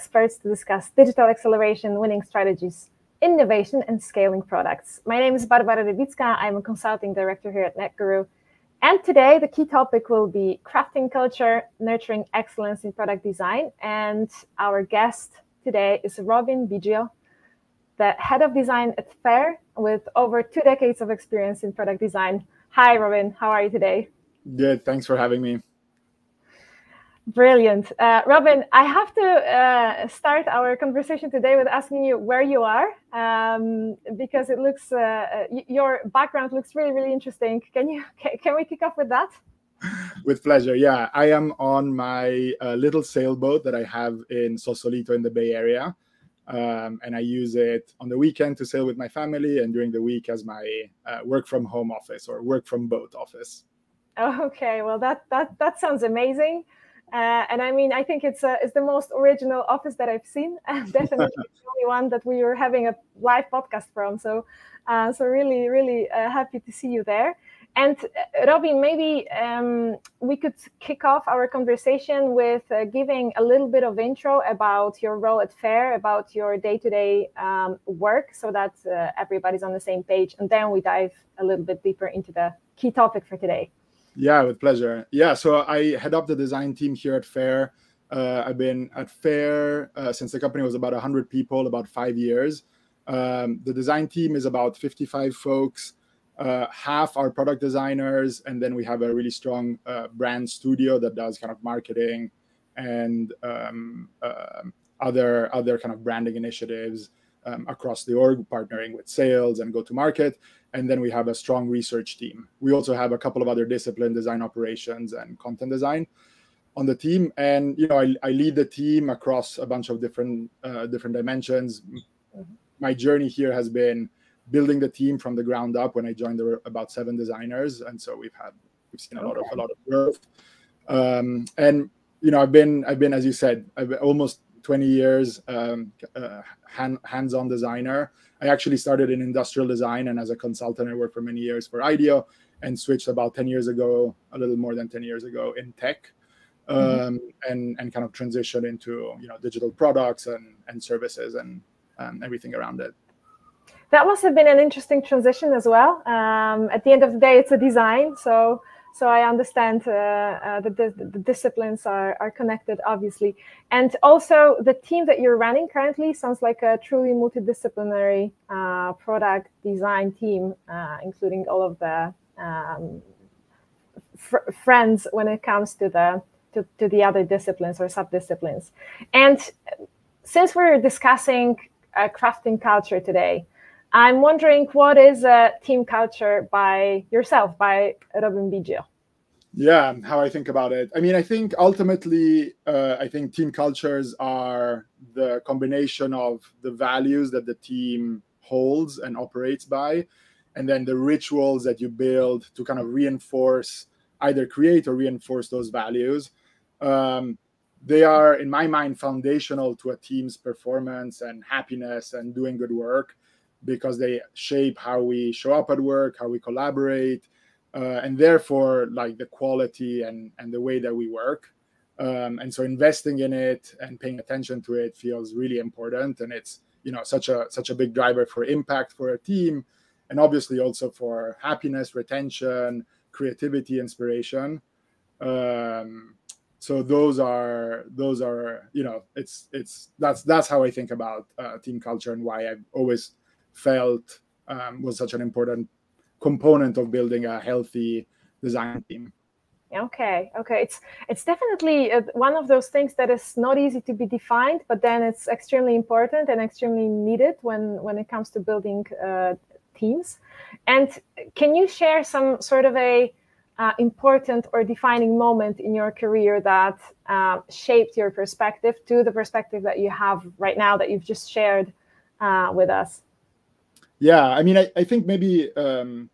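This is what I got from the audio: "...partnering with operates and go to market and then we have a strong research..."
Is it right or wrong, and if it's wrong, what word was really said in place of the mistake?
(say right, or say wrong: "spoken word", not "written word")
wrong: "sales", not "operates".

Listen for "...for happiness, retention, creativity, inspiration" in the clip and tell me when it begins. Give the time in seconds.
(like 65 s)
230 s.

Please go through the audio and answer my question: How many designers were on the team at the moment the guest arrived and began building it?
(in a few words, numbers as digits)
7.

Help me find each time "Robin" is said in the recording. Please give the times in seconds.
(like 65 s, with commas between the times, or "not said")
16 s, 22 s, 28 s, 68 s, 188 s.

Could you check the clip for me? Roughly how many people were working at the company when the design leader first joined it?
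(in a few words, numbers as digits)
100.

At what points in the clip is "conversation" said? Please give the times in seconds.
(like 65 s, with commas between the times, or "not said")
30 s, 71 s.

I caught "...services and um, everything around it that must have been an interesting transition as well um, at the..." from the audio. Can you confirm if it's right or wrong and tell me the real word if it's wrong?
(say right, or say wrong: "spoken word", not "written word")
right.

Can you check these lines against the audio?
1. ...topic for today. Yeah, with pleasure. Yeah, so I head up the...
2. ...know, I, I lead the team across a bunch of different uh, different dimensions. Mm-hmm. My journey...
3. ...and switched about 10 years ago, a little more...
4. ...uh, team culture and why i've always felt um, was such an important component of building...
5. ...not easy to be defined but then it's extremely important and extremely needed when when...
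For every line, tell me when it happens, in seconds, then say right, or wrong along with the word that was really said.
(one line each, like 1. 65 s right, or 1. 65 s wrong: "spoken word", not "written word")
1. 82 s right
2. 117 s right
3. 142 s right
4. 241 s right
5. 253 s right.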